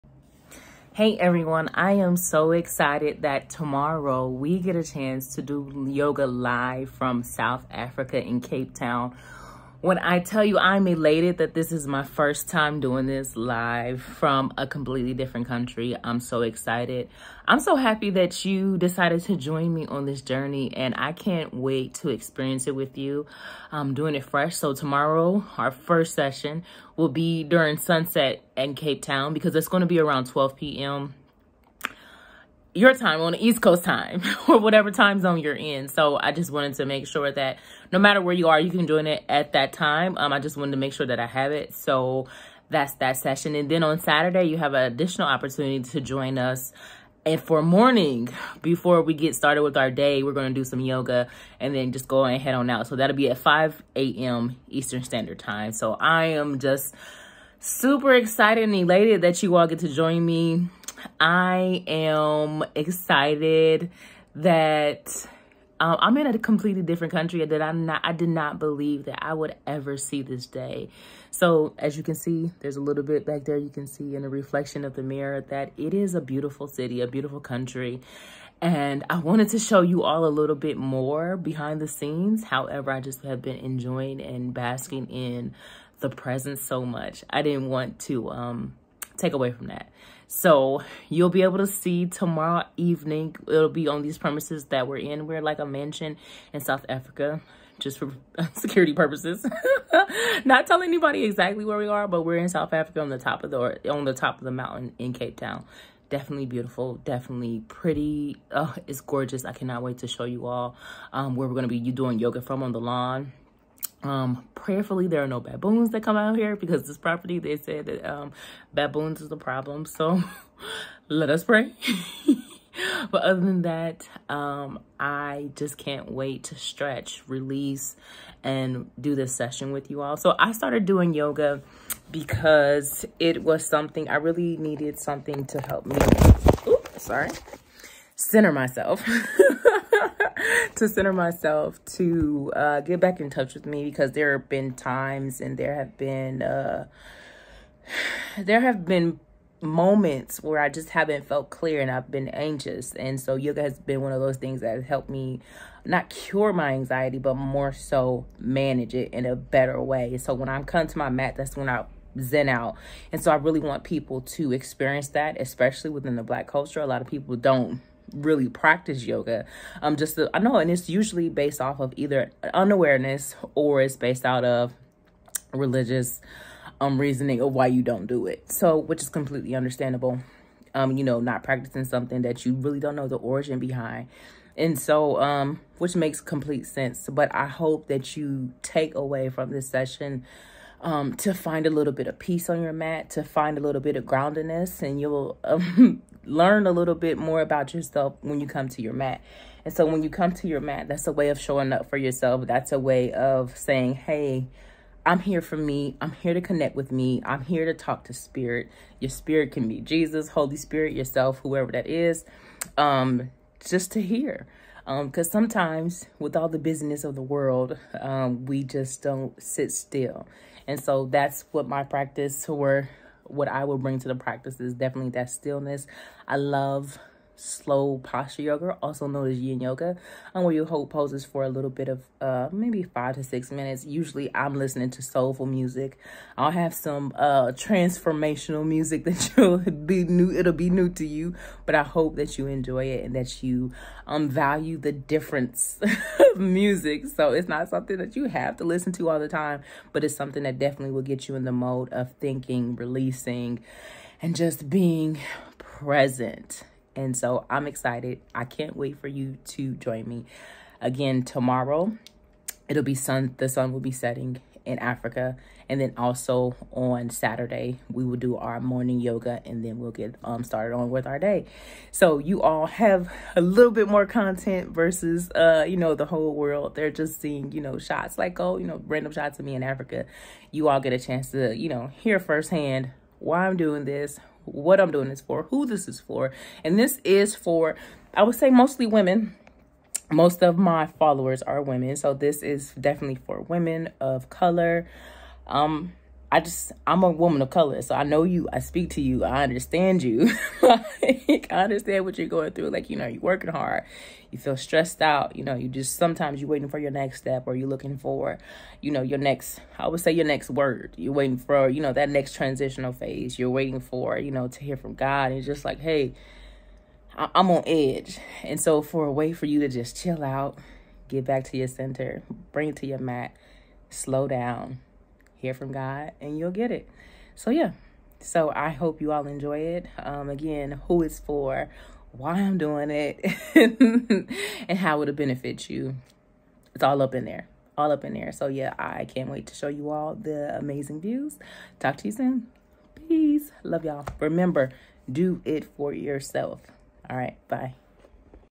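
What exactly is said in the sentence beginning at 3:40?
And so that's what my practice or what I will bring to the practice is definitely that stillness.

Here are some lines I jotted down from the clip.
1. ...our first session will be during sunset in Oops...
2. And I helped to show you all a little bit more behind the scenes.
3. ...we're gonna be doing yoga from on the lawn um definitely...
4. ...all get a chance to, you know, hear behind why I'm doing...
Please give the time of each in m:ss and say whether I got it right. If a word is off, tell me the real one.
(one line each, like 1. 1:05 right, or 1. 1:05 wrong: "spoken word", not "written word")
1. 0:25 wrong: "Cape", not "Oops"
2. 1:18 wrong: "wanted", not "helped"
3. 1:51 wrong: "prayerfully", not "definitely"
4. 4:40 wrong: "firsthand", not "behind".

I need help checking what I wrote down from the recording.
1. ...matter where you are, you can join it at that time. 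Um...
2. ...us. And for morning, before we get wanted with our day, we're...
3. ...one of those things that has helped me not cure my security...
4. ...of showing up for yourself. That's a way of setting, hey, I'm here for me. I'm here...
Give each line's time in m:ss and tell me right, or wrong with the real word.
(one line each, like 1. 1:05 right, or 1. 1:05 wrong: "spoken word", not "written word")
1. 0:37 right
2. 0:46 wrong: "started", not "wanted"
3. 2:34 wrong: "anxiety", not "security"
4. 3:21 wrong: "saying", not "setting".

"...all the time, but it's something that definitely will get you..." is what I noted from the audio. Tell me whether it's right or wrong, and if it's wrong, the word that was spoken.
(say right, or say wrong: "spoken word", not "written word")
right.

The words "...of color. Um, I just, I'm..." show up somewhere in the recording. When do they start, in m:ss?
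4:54.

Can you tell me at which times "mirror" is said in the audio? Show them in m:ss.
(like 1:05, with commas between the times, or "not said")
1:15.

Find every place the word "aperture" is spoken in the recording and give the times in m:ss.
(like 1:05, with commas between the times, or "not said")
not said.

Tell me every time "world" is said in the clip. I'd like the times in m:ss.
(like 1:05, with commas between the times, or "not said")
3:37, 4:36.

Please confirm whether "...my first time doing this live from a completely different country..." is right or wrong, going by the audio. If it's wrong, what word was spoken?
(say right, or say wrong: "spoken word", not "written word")
right.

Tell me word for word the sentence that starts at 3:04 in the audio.
And so, um, which makes complete sense.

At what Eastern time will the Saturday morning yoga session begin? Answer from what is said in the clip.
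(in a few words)
5 a.m.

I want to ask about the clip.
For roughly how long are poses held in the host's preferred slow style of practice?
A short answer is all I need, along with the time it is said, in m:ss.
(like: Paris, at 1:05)
5 to 6 minutes, at 3:52.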